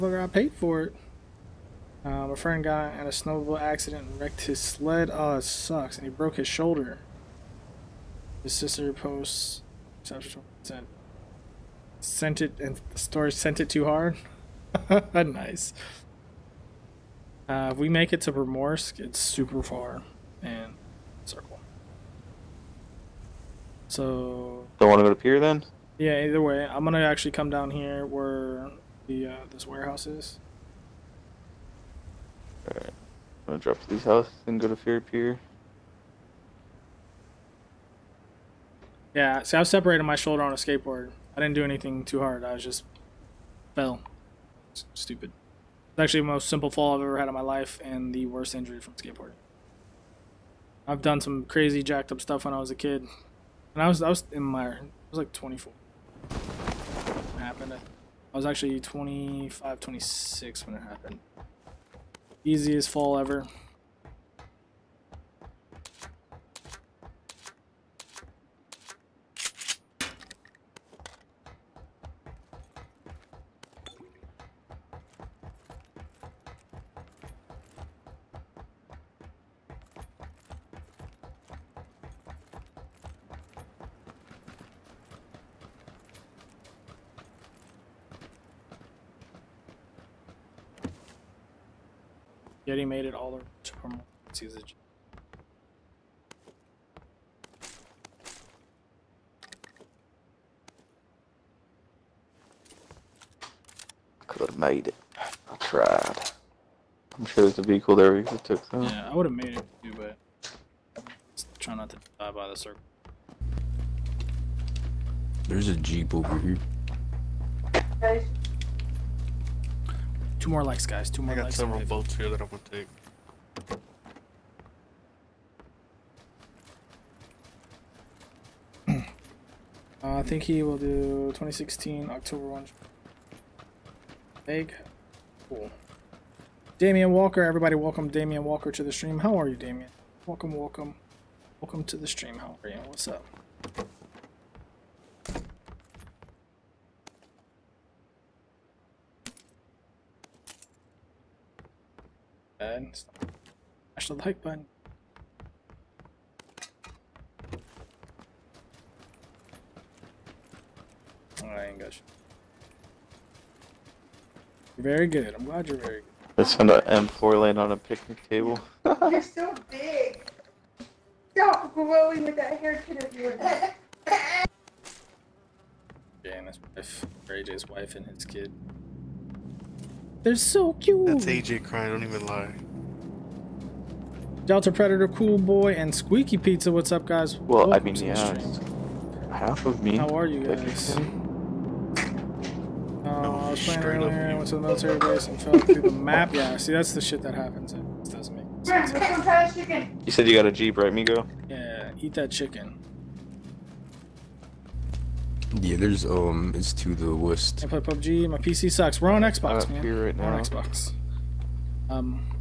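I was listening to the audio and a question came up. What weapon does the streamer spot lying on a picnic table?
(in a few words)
M4.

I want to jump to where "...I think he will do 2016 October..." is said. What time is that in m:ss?
2:10.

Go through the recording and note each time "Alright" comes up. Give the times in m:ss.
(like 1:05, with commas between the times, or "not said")
0:32, 2:41.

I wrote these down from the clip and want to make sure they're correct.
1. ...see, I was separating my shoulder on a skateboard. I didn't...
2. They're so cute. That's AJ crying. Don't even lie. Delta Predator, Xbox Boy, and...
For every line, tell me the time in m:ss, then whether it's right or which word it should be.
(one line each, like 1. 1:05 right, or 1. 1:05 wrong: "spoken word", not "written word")
1. 0:39 right
2. 3:00 wrong: "Cool", not "Xbox".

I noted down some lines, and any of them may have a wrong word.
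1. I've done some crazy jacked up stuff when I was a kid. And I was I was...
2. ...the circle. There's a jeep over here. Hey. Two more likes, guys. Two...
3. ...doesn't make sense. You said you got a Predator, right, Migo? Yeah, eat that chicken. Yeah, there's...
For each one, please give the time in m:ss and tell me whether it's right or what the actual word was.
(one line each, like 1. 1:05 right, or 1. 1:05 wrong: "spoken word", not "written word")
1. 0:50 right
2. 1:52 right
3. 3:18 wrong: "Jeep", not "Predator".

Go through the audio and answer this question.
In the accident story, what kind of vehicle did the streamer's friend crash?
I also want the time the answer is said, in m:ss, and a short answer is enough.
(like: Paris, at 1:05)
Snowmobile, at 0:03.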